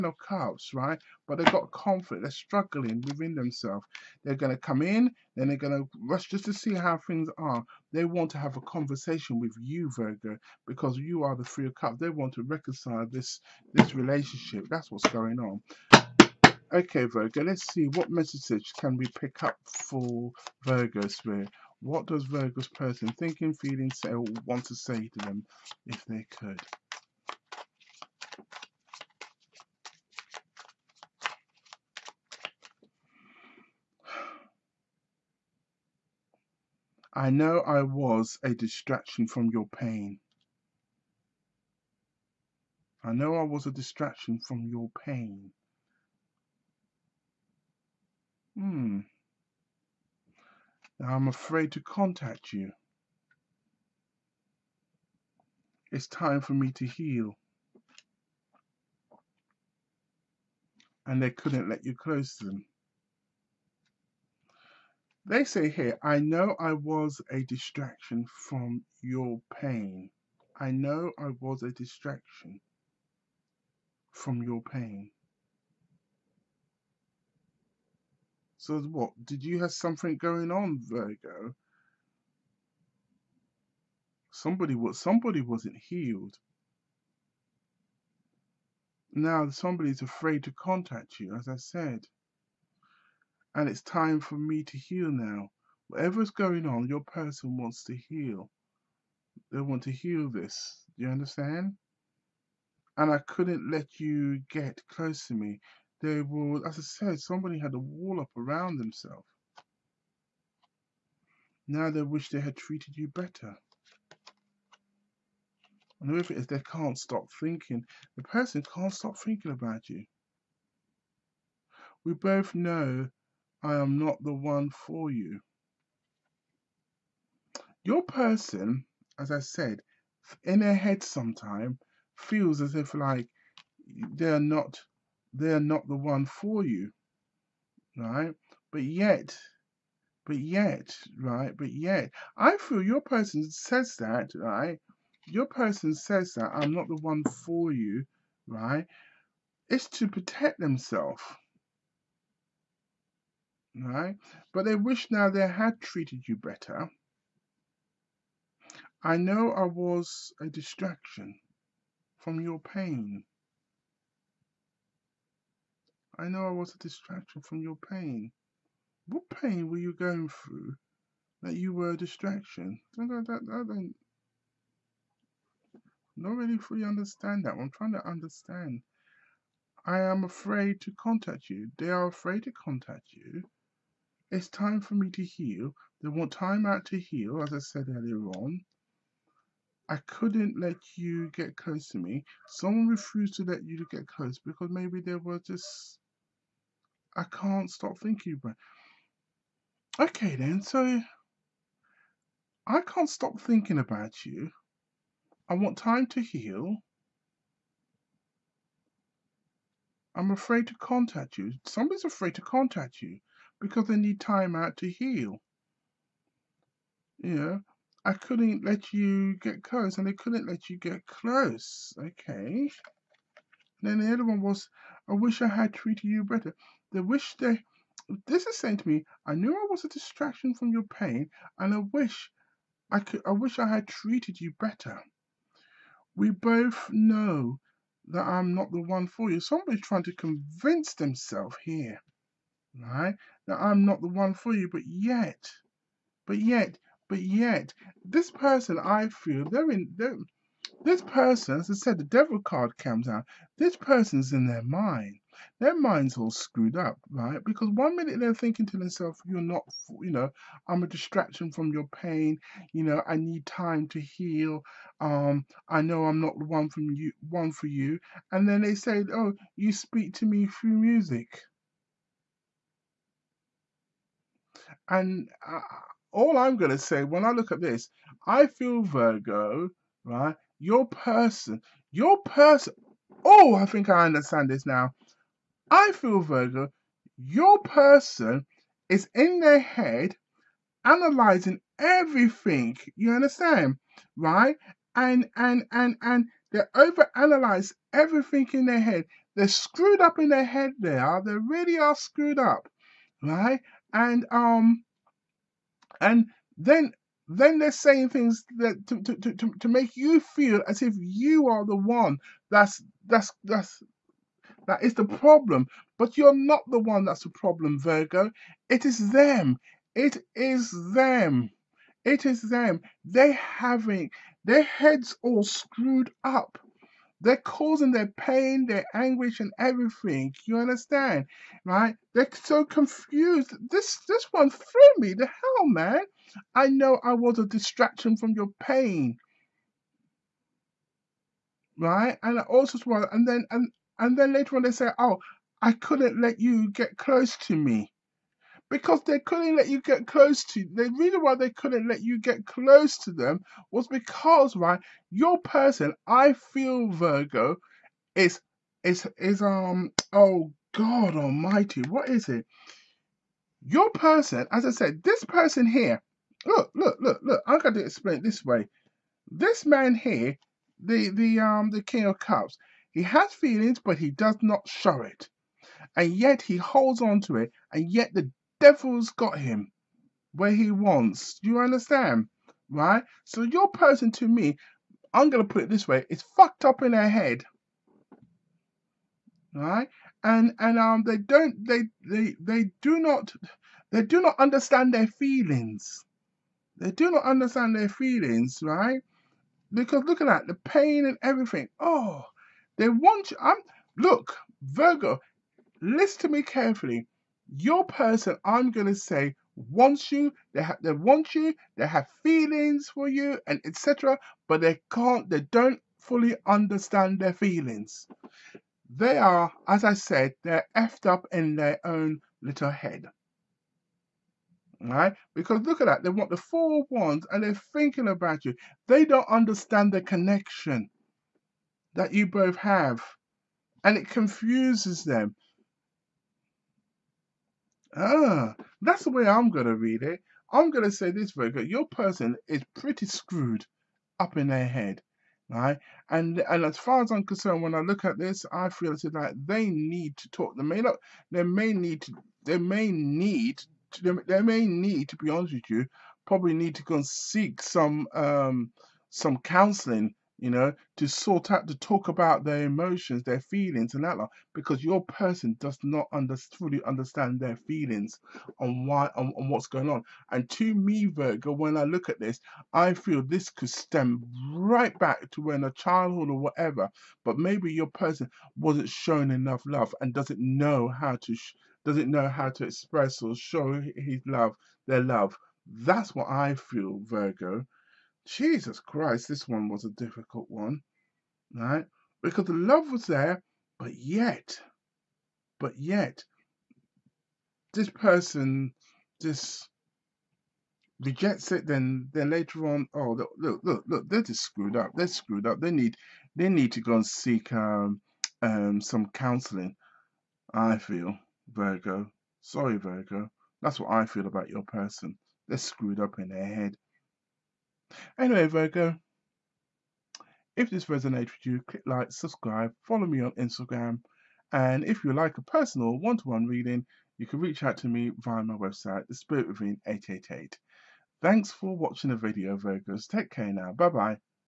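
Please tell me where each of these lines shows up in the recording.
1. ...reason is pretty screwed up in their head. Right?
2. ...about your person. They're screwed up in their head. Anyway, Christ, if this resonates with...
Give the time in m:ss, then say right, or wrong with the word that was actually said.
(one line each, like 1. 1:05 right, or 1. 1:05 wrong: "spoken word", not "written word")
1. 7:21 wrong: "person", not "reason"
2. 8:34 wrong: "Virgo", not "Christ".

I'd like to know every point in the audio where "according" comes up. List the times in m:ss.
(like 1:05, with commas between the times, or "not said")
not said.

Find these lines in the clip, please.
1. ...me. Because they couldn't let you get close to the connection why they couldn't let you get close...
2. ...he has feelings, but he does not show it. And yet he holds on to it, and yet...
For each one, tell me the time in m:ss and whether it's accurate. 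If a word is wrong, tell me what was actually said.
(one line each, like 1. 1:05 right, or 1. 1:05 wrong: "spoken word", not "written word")
1. 5:47 wrong: "reason", not "connection"
2. 6:12 right.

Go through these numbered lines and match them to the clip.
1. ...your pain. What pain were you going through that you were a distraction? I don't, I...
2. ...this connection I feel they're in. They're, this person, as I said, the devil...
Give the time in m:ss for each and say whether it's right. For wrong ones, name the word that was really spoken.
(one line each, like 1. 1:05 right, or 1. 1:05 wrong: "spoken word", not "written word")
1. 2:47 right
2. 4:08 wrong: "person", not "connection".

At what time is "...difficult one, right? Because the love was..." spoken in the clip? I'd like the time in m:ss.
8:09.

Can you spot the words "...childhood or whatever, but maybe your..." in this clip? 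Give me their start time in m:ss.
7:55.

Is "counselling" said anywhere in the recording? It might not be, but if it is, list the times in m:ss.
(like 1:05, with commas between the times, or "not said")
7:39, 8:29.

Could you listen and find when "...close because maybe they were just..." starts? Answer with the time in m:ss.
3:14.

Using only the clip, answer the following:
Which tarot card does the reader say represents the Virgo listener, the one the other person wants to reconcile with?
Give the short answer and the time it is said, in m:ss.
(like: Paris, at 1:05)
Three of Cups, at 0:11.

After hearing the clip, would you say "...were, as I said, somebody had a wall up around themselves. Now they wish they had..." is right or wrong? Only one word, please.
right.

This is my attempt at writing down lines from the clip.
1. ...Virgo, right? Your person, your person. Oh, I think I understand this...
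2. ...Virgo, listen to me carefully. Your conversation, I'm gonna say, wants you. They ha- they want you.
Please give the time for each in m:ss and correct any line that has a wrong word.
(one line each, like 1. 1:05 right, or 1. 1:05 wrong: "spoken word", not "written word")
1. 4:38 right
2. 6:44 wrong: "person", not "conversation".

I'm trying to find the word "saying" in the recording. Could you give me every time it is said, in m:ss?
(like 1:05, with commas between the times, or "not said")
3:48, 5:07.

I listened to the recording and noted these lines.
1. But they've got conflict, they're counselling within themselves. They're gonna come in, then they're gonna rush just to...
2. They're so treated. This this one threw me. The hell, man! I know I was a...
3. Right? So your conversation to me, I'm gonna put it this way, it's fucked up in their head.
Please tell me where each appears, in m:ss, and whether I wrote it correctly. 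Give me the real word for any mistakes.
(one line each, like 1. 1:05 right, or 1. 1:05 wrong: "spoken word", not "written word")
1. 0:01 wrong: "struggling", not "counselling"
2. 5:32 wrong: "confused", not "treated"
3. 6:22 wrong: "person", not "conversation".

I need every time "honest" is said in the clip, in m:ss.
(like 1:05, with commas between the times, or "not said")
7:35.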